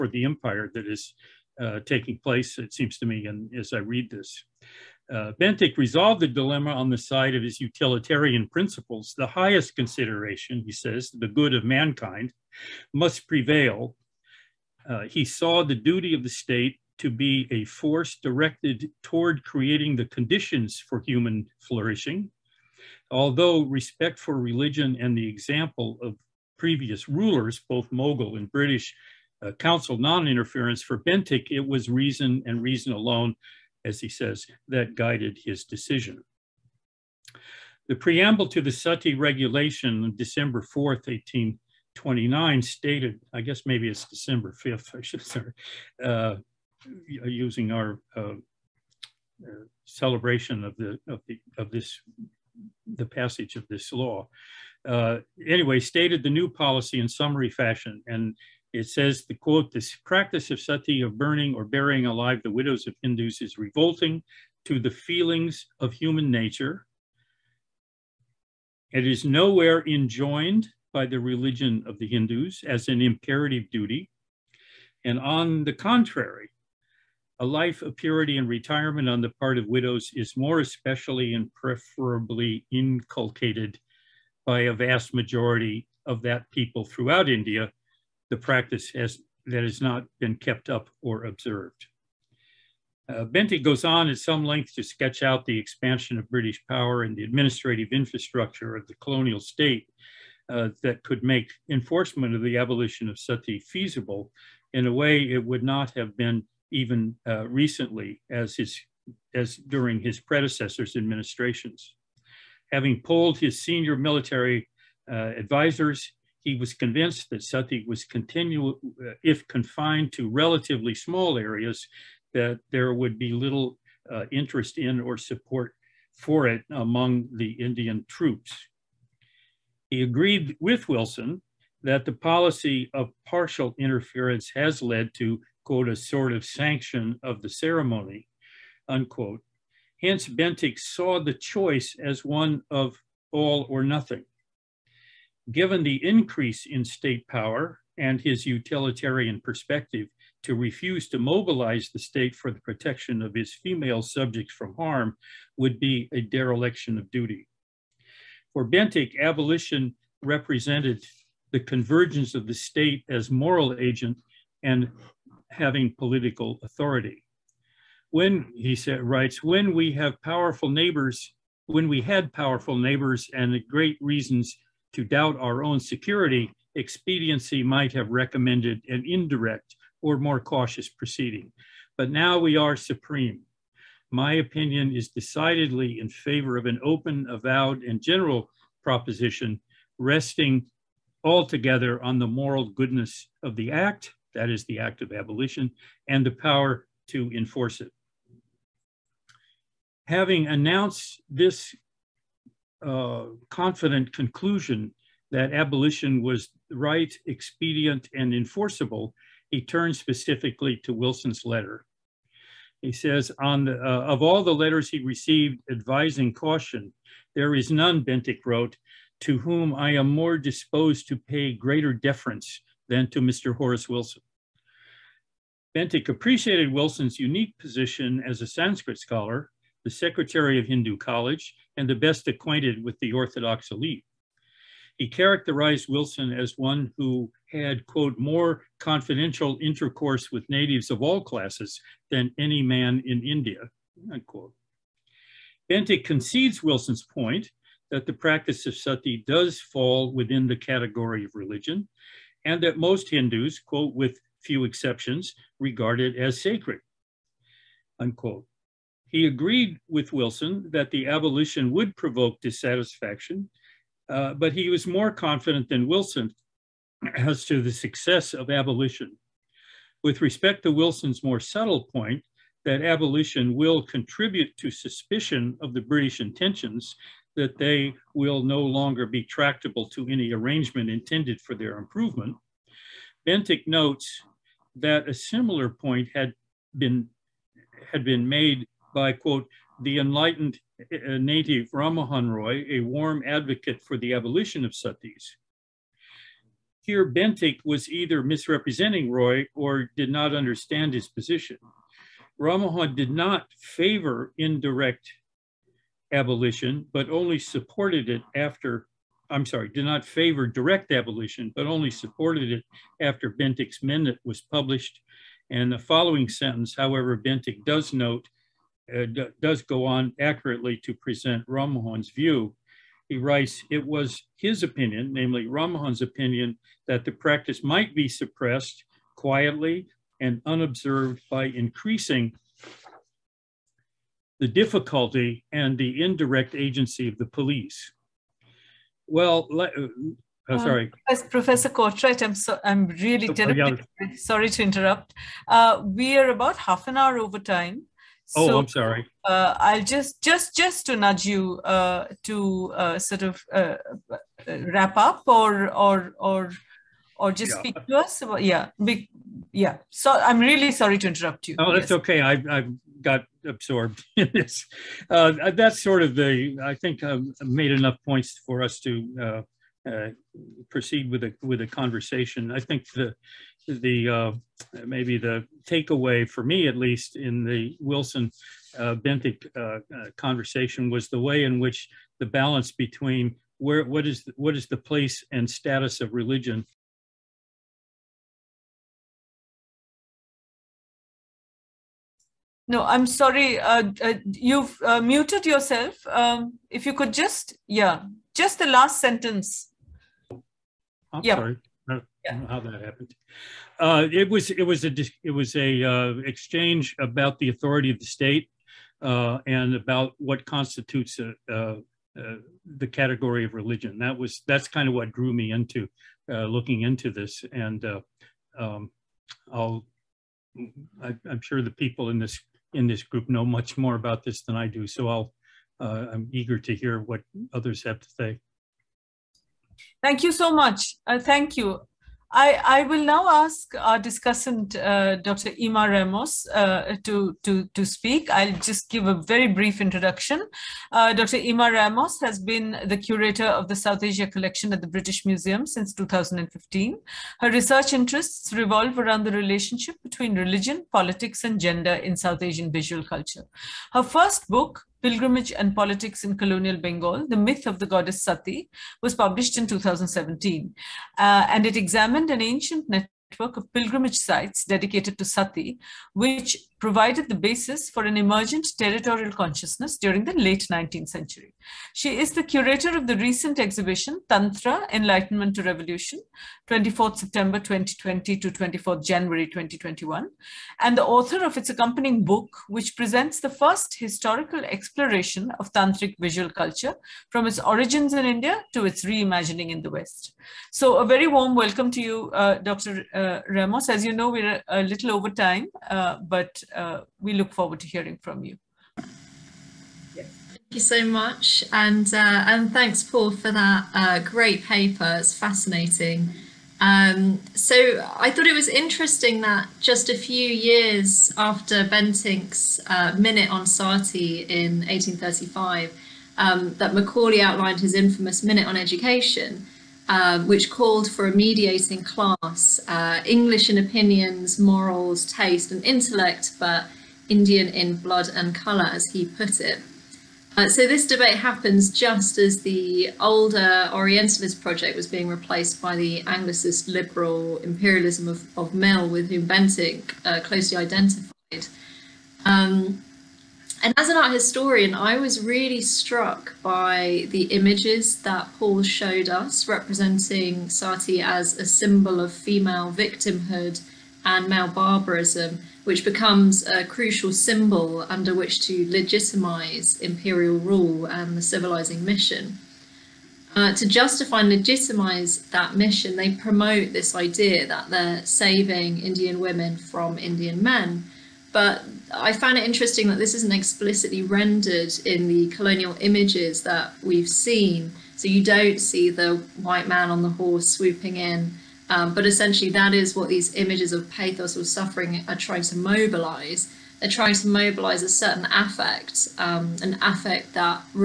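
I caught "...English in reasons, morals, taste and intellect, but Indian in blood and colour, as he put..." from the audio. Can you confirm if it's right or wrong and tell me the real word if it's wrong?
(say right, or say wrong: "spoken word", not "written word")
wrong: "opinions", not "reasons".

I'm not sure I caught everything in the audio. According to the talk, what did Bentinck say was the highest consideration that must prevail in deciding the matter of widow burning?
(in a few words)
the good of mankind.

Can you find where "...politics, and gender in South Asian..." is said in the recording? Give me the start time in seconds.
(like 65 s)
450 s.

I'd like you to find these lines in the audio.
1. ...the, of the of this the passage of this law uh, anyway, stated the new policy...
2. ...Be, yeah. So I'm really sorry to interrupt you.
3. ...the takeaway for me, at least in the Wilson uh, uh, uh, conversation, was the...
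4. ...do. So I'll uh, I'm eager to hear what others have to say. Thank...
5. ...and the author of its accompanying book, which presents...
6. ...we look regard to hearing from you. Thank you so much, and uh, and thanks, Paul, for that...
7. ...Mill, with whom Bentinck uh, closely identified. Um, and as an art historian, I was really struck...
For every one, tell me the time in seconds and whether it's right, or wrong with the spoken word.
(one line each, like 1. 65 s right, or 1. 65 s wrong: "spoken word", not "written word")
1. 50 s right
2. 358 s right
3. 375 s right
4. 424 s right
5. 480 s right
6. 497 s wrong: "forward", not "regard"
7. 538 s right.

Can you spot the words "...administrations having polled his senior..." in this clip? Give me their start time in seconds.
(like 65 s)
110 s.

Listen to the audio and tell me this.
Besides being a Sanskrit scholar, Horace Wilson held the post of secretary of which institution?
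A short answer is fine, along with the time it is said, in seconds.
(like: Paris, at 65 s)
Hindu College, at 230 s.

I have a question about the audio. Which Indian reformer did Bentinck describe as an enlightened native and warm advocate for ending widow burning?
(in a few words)
Rammohun Roy.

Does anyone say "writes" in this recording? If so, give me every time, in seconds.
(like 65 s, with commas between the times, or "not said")
169 s, 323 s.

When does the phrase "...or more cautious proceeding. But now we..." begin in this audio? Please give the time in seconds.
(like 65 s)
179 s.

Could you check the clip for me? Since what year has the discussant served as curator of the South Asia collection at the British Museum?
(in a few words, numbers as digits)
2015.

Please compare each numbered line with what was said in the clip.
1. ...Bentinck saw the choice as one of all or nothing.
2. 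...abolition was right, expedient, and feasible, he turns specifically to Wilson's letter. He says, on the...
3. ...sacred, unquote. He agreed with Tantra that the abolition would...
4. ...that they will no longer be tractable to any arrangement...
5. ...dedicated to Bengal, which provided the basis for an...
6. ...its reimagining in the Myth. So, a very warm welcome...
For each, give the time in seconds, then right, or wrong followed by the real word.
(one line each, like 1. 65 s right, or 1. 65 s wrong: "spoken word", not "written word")
1. 140 s right
2. 205 s wrong: "enforceable", not "feasible"
3. 256 s wrong: "Wilson", not "Tantra"
4. 277 s right
5. 464 s wrong: "Sati", not "Bengal"
6. 488 s wrong: "West", not "Myth".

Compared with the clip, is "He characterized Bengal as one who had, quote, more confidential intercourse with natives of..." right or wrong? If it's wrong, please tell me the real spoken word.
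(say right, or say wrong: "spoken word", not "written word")
wrong: "Wilson", not "Bengal".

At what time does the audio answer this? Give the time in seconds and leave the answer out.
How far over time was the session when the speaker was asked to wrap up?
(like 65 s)
346 s.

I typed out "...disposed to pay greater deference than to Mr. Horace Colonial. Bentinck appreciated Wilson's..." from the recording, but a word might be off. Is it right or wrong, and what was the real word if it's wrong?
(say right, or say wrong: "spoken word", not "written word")
wrong: "Wilson", not "Colonial".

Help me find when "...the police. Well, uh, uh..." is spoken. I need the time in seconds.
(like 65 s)
337 s.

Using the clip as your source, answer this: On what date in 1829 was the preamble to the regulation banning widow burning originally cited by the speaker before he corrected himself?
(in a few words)
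December 4th.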